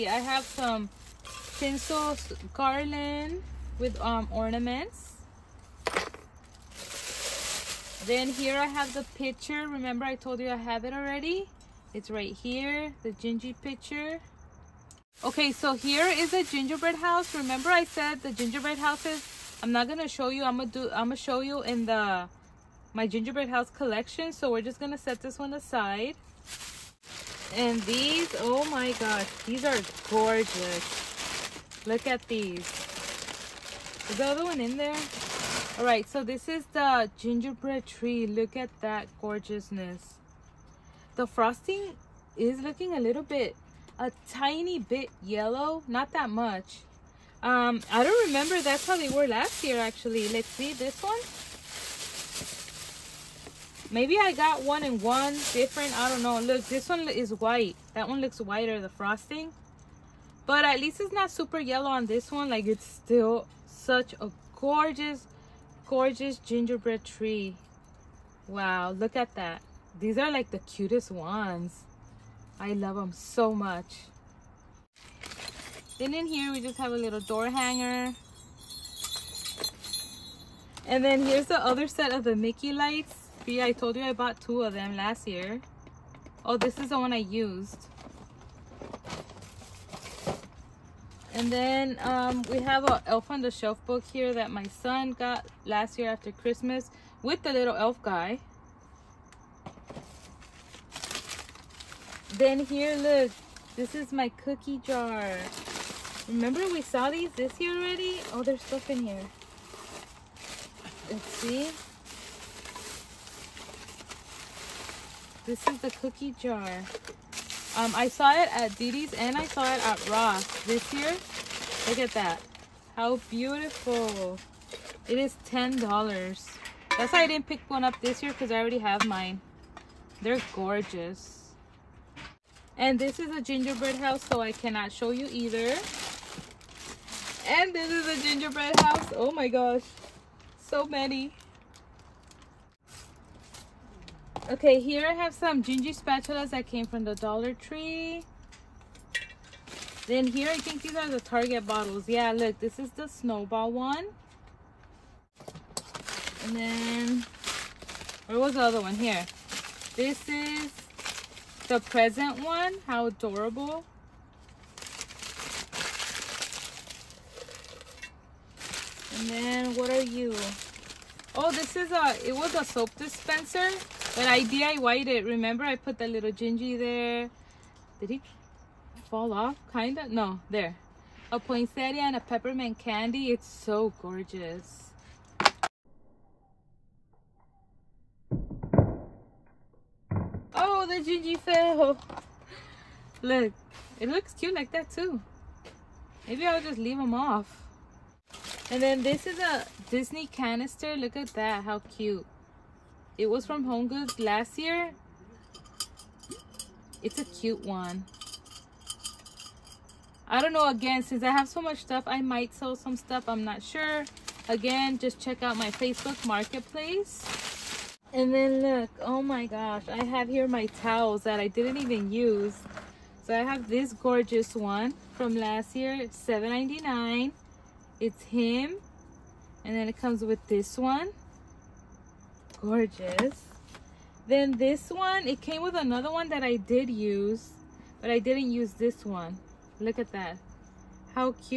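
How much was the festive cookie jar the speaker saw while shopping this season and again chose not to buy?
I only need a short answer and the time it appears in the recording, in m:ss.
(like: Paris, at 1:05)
$10, at 2:05.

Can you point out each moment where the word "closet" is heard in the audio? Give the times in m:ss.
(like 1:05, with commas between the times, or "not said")
not said.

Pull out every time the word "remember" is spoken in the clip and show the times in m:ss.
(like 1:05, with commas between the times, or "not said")
0:09, 0:17, 0:48, 1:46, 2:55.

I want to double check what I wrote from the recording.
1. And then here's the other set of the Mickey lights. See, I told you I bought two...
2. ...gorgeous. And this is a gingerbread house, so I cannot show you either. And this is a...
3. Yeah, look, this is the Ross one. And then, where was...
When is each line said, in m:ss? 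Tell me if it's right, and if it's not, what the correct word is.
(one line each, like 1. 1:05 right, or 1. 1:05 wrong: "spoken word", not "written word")
1. 1:20 right
2. 2:10 right
3. 2:32 wrong: "Snowball", not "Ross".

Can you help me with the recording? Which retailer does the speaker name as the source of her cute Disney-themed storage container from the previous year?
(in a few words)
Home Goods.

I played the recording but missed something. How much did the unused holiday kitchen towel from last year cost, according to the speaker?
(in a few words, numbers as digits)
$7.99.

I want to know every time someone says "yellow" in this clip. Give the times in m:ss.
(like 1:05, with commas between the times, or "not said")
0:45, 1:01.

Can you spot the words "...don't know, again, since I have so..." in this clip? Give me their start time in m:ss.
3:30.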